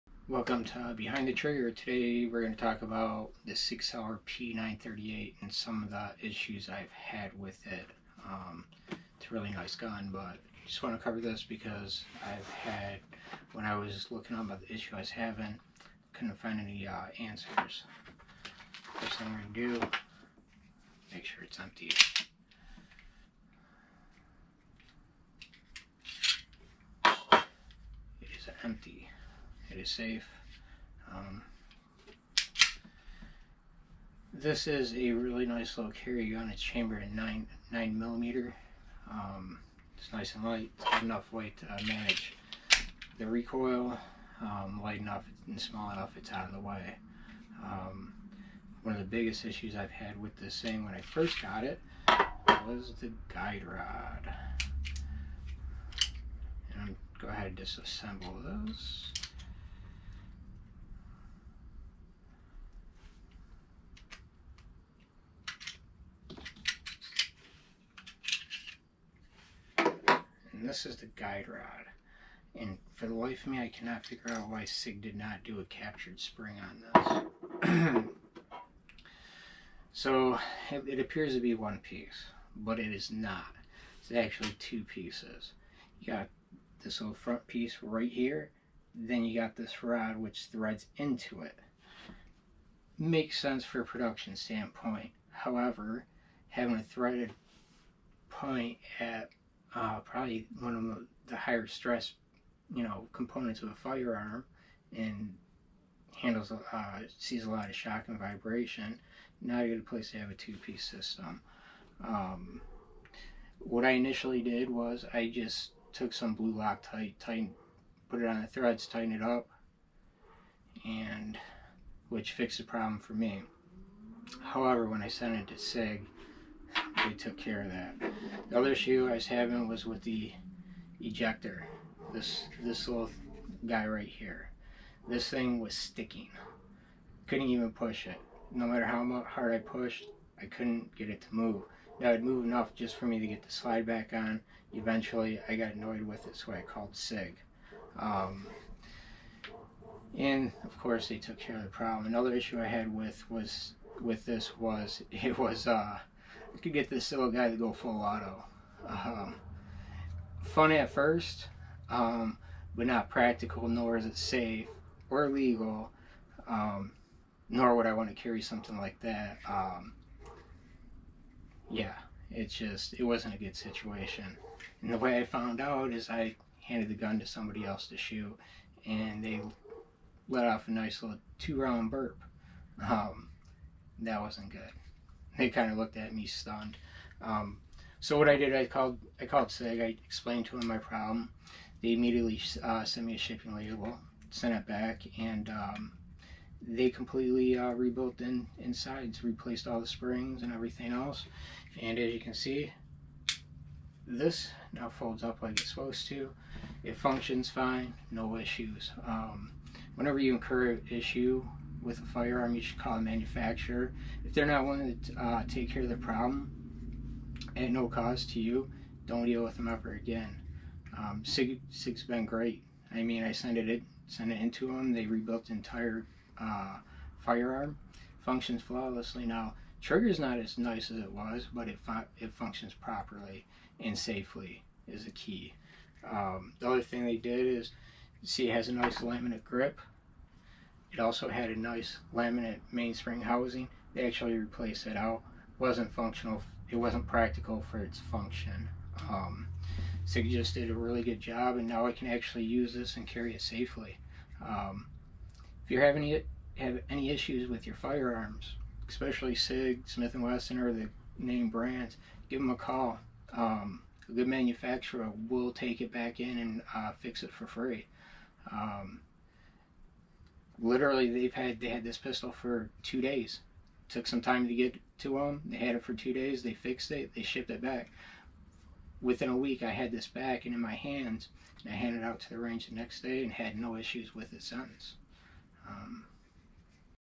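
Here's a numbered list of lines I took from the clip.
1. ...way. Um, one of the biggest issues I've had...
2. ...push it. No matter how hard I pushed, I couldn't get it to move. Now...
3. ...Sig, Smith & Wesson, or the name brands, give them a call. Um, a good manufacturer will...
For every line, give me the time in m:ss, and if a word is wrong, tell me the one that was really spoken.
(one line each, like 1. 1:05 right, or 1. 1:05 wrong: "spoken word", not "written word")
1. 0:46 right
2. 2:17 right
3. 4:19 right.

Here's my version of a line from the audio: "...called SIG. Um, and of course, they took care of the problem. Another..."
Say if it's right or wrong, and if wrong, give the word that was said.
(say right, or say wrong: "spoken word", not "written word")
right.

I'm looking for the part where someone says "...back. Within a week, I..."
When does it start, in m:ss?
4:37.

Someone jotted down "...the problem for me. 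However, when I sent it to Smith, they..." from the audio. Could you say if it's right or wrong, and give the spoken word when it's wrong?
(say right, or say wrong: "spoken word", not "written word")
wrong: "SIG", not "Smith".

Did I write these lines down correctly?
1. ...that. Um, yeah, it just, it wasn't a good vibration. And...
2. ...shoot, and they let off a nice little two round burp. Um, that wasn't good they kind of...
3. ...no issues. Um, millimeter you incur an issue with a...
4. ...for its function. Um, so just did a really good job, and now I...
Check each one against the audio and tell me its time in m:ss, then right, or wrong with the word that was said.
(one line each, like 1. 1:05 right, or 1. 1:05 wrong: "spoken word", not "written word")
1. 2:49 wrong: "situation", not "vibration"
2. 2:57 right
3. 3:28 wrong: "whenever", not "millimeter"
4. 4:07 right.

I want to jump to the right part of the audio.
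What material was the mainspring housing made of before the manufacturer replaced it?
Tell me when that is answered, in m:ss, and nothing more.
4:02.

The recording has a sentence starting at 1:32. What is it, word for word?
Makes sense for a production standpoint.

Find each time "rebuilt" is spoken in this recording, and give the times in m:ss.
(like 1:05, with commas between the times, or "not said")
3:17, 3:45.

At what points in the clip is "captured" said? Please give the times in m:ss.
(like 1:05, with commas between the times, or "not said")
1:15.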